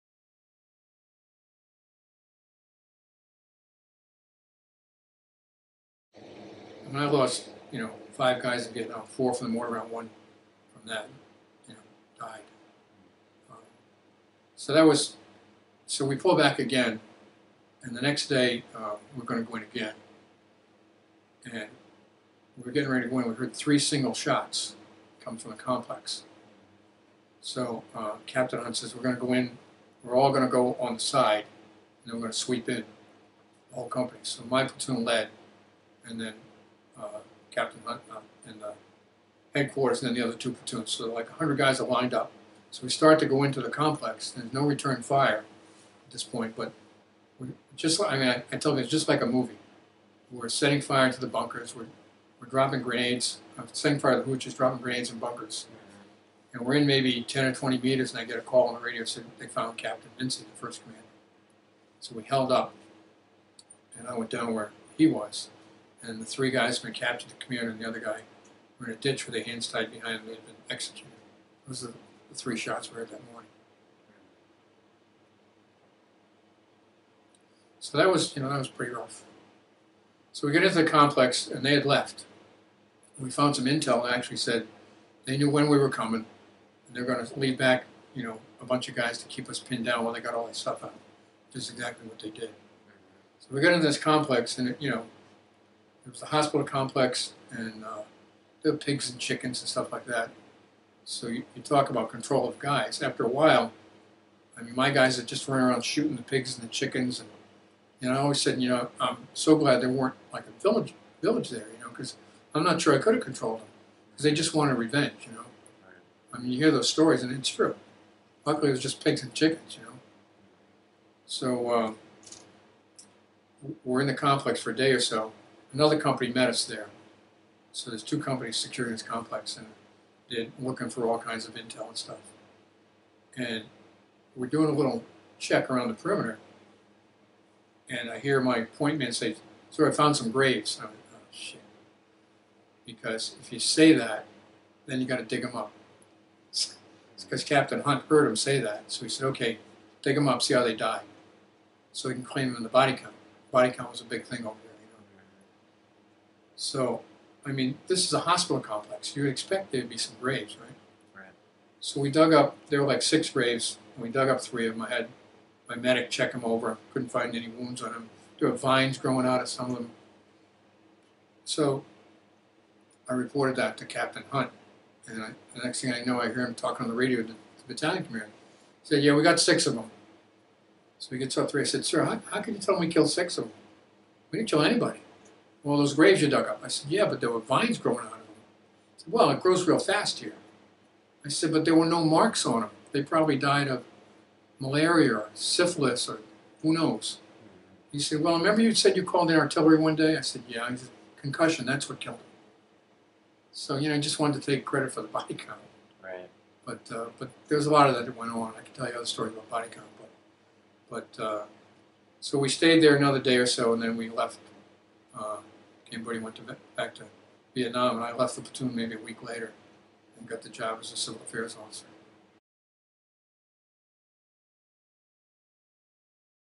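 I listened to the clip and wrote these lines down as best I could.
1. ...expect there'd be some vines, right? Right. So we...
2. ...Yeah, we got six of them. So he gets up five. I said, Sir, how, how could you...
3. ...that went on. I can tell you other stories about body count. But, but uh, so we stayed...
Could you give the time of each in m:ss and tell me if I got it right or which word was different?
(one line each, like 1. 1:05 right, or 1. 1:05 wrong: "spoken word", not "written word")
1. 2:39 wrong: "graves", not "vines"
2. 2:59 wrong: "three", not "five"
3. 3:28 right.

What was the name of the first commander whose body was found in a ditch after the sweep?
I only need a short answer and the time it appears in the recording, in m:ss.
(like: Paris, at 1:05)
Captain Vincent, at 0:59.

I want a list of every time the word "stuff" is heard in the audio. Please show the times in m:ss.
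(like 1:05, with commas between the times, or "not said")
1:30, 1:39, 2:11.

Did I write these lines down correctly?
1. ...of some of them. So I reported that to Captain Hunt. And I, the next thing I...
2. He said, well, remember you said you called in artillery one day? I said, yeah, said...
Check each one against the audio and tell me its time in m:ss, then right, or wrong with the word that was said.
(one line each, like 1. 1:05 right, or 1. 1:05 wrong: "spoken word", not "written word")
1. 2:49 right
2. 3:17 right.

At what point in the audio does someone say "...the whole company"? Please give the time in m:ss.
0:33.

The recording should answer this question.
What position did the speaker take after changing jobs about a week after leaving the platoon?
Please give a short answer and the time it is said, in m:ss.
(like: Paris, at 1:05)
civil affairs officer, at 3:40.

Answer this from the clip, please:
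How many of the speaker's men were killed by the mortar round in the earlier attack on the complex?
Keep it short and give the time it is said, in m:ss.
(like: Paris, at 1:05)
4, at 0:09.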